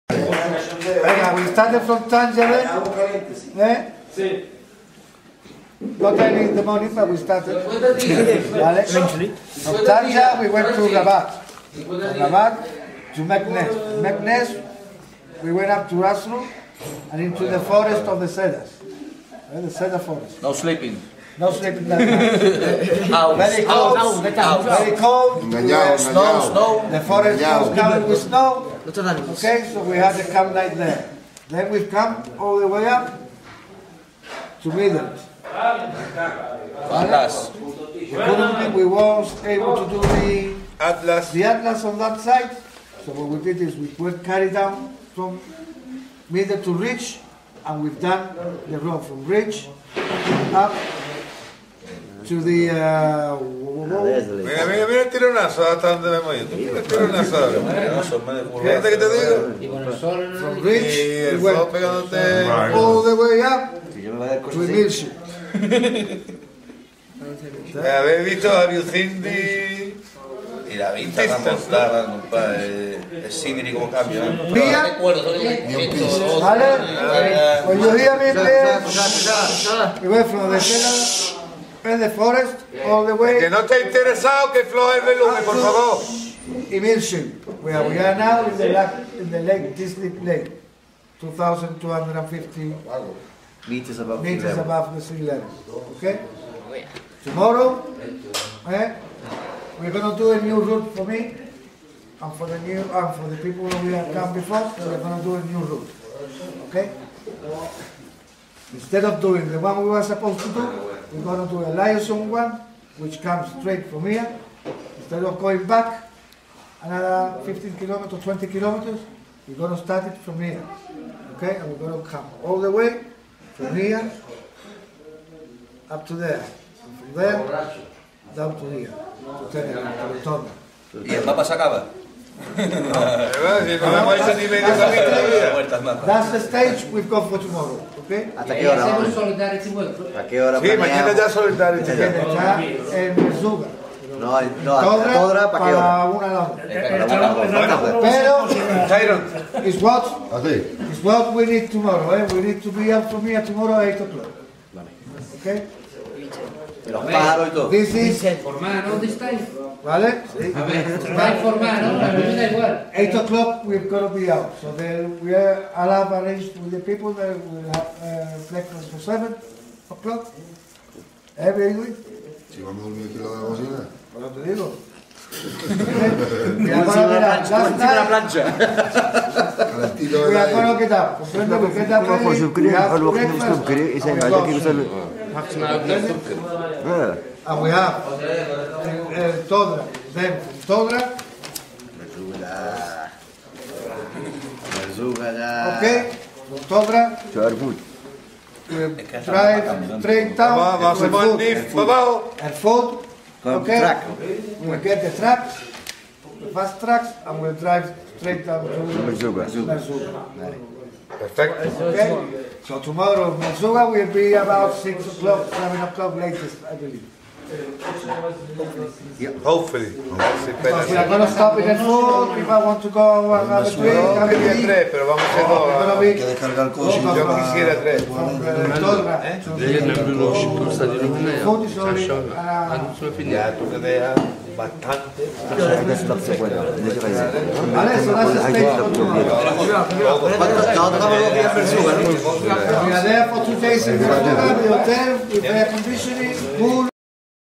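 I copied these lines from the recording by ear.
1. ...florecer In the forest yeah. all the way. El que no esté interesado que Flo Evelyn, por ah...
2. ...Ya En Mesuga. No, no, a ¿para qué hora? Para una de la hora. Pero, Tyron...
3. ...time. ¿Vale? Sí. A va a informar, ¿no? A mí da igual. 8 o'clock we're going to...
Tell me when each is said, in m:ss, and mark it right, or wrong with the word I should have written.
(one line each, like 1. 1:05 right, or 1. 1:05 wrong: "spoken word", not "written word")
1. 1:20 right
2. 2:21 right
3. 2:39 right.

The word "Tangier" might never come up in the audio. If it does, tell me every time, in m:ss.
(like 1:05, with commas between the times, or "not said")
0:02, 0:09.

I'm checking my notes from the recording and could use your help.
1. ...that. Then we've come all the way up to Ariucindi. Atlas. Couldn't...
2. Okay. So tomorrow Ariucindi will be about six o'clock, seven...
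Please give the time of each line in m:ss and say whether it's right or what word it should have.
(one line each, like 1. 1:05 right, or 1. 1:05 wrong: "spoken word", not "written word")
1. 0:30 wrong: "Midland", not "Ariucindi"
2. 3:31 wrong: "Merzouga", not "Ariucindi".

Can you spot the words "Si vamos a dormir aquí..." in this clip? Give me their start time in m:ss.
2:52.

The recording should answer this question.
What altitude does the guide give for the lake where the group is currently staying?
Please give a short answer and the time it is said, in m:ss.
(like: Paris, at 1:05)
2,250 meters, at 1:31.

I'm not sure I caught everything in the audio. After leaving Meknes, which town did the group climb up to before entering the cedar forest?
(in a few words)
Azrou.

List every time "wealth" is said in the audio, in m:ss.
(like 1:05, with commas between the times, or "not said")
not said.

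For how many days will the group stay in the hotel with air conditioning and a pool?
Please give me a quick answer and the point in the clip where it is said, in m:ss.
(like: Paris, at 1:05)
2, at 4:03.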